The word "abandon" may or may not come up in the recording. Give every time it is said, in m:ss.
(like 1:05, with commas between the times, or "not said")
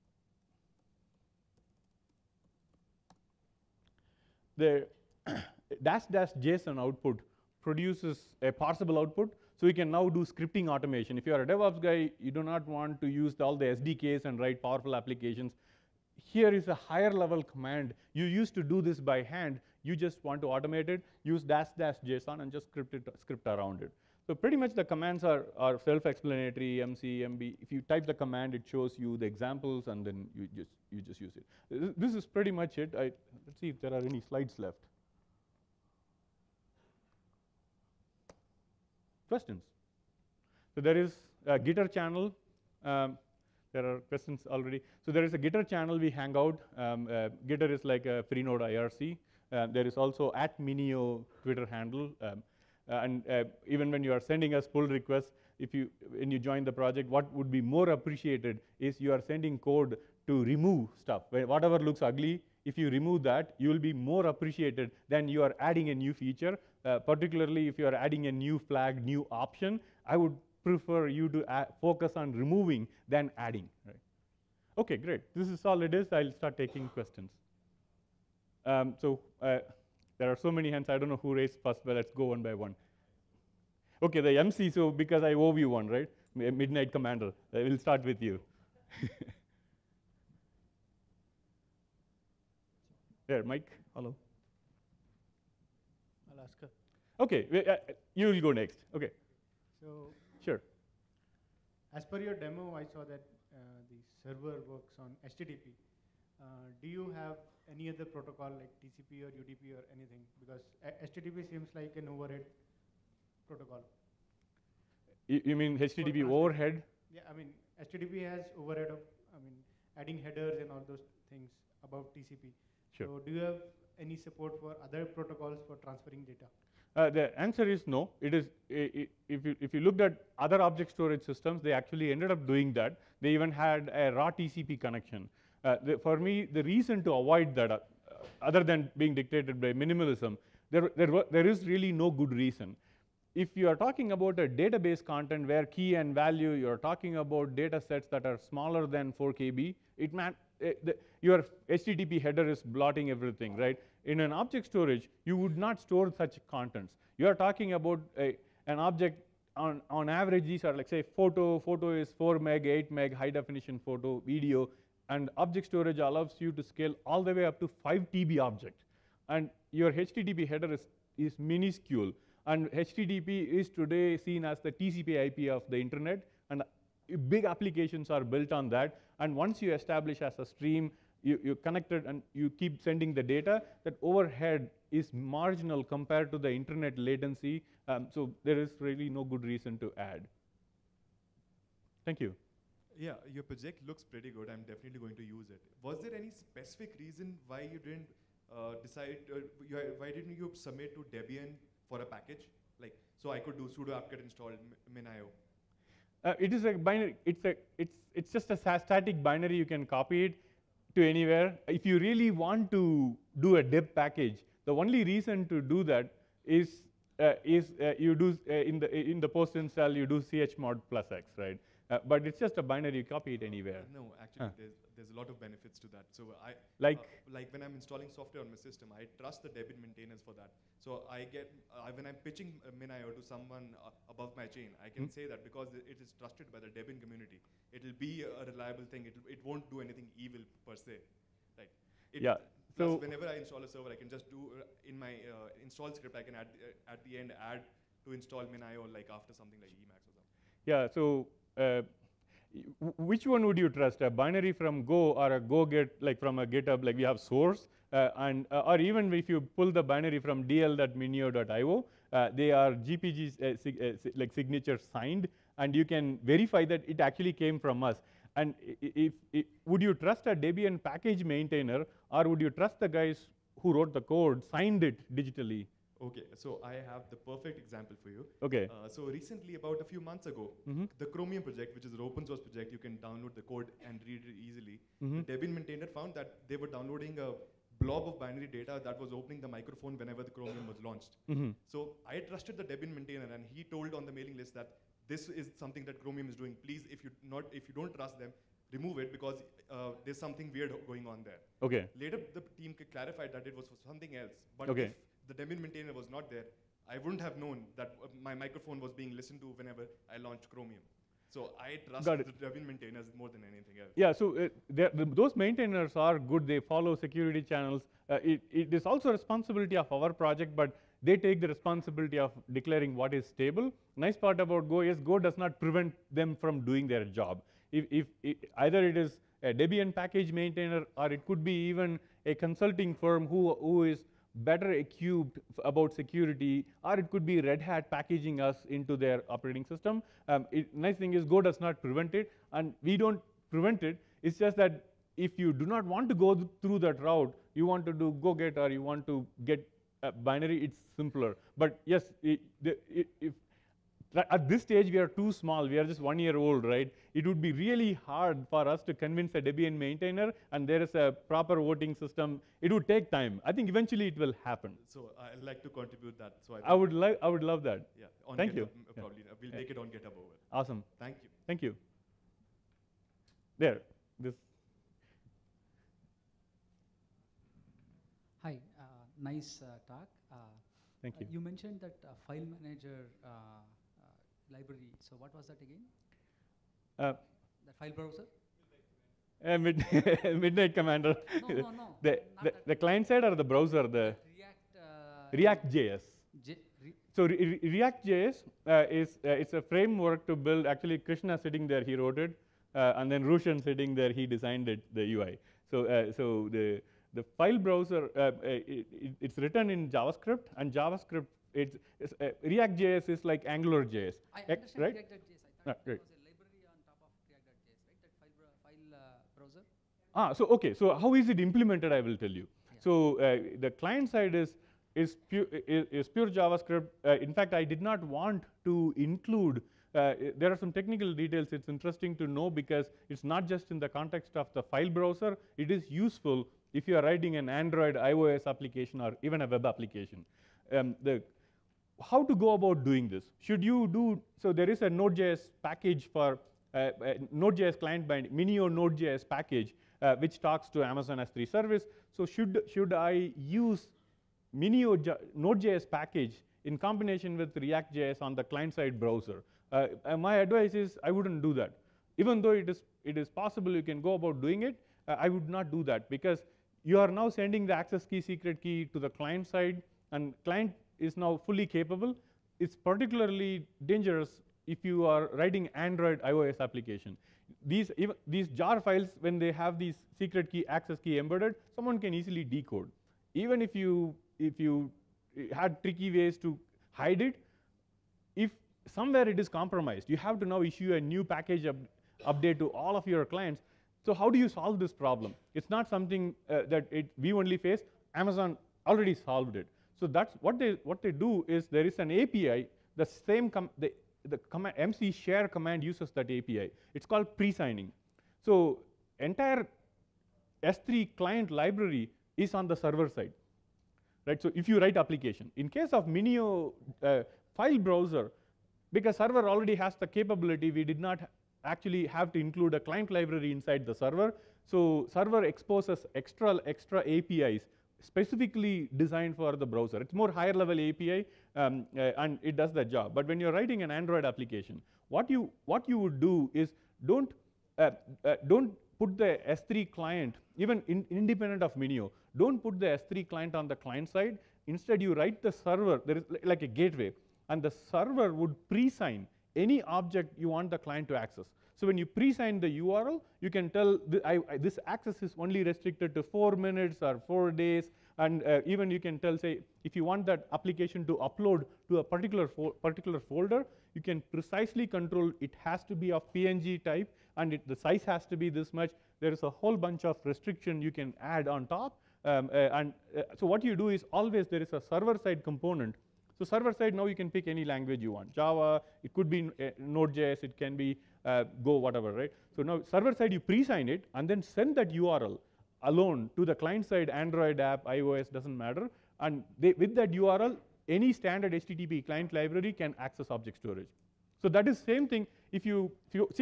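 not said.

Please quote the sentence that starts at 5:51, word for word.
But yes, it, the, it, if at this stage we are too small, we are just one year old, right?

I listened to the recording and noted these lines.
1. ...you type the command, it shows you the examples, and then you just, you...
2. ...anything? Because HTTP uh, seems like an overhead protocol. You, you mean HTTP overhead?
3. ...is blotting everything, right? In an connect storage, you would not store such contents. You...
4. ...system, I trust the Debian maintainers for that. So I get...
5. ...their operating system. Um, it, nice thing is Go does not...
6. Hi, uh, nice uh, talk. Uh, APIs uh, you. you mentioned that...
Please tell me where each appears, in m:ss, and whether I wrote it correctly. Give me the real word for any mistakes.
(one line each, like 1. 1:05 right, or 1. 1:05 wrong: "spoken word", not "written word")
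1. 0:27 right
2. 1:49 right
3. 2:32 wrong: "object", not "connect"
4. 3:48 right
5. 5:38 right
6. 6:18 wrong: "Thank", not "APIs".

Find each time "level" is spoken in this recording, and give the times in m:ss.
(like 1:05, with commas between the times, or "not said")
0:17, 8:50.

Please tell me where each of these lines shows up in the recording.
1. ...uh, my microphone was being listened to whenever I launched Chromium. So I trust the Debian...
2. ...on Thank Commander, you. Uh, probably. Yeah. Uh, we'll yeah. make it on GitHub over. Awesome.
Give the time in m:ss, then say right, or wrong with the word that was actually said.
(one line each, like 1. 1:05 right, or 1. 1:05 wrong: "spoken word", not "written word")
1. 5:08 right
2. 6:08 wrong: "GitHub", not "Commander".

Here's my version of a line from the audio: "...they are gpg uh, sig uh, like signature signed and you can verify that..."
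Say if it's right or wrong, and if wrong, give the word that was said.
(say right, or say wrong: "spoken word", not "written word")
right.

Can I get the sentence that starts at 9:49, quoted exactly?
And they, with that URL, any standard HTTP client library can access object storage.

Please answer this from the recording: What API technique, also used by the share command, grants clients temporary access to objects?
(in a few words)
pre-signing.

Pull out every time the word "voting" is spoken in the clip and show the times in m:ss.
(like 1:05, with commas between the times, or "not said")
6:01.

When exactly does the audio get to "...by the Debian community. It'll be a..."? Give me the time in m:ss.
3:56.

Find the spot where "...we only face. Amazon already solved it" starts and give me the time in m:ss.
8:17.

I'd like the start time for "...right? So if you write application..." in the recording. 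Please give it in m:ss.
8:34.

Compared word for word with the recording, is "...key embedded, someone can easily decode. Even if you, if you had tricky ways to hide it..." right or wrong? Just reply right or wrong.
right.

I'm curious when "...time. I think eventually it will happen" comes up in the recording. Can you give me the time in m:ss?
6:03.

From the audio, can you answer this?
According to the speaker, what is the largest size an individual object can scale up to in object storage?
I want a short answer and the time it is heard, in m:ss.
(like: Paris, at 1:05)
5 TB, at 2:47.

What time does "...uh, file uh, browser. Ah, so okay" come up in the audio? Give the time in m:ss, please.
6:58.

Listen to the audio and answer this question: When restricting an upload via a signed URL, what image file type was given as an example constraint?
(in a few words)
PNG.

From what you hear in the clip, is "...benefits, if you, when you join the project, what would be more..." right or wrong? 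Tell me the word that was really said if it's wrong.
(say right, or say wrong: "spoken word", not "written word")
wrong: "requests", not "benefits".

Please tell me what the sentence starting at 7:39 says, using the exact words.
Uh, uh, my advice is I wouldn't do that.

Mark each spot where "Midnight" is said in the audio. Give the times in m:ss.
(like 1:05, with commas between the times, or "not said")
1:26, 6:30.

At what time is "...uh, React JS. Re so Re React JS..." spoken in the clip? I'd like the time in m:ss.
6:34.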